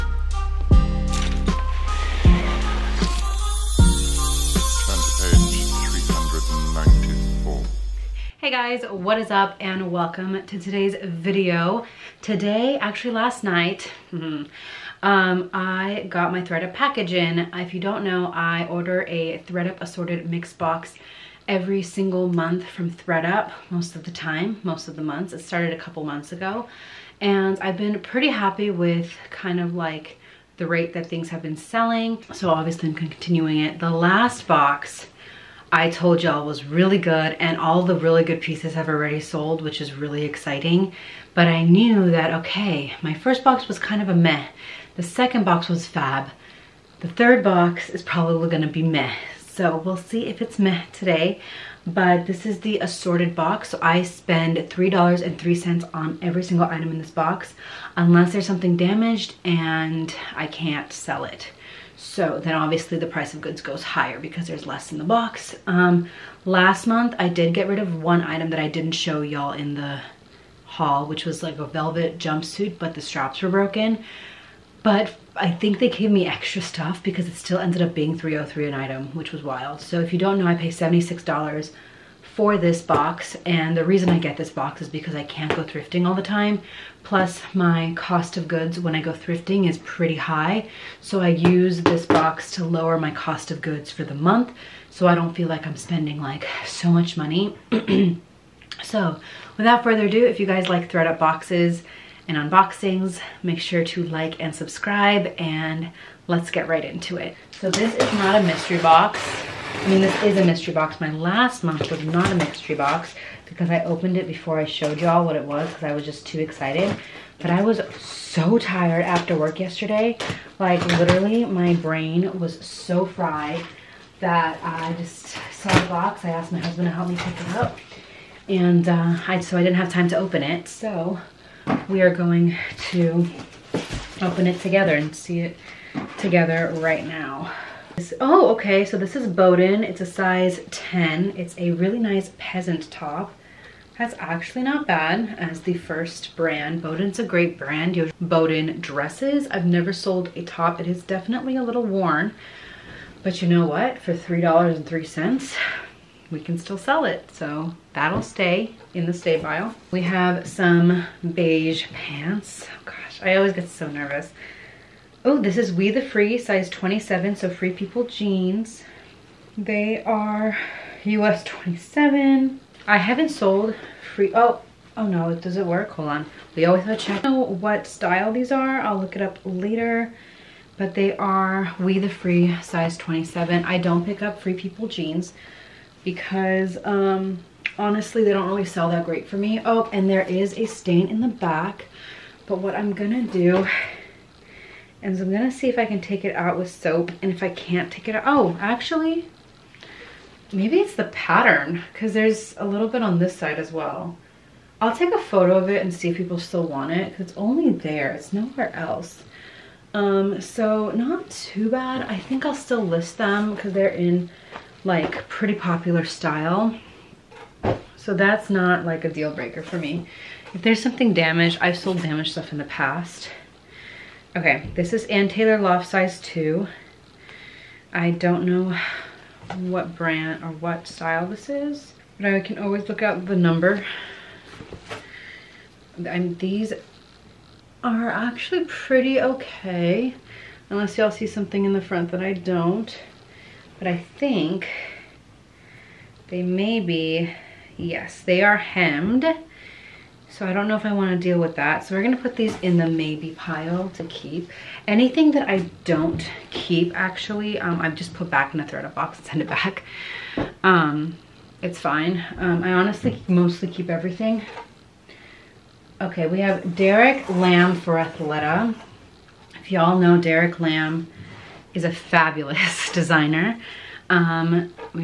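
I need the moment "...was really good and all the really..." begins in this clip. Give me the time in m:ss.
0:36.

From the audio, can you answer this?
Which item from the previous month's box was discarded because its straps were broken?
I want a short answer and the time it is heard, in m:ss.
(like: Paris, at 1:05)
velvet jumpsuit, at 1:11.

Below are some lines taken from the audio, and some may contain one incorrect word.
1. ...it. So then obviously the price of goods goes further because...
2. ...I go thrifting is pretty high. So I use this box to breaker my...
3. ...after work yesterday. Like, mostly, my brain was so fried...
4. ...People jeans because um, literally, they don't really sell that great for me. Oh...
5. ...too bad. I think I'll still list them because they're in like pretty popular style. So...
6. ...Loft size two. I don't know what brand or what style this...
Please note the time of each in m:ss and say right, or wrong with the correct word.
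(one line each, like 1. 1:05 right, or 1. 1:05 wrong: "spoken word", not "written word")
1. 1:01 wrong: "higher", not "further"
2. 1:28 wrong: "lower", not "breaker"
3. 1:59 wrong: "literally", not "mostly"
4. 3:04 wrong: "honestly", not "literally"
5. 3:31 right
6. 3:45 right.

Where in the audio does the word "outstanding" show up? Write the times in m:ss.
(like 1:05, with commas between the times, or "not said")
not said.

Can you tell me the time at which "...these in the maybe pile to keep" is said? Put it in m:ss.
4:12.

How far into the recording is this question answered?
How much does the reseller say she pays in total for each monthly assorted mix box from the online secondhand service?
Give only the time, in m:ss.
1:20.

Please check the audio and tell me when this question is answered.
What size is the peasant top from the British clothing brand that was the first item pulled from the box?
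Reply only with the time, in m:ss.
2:20.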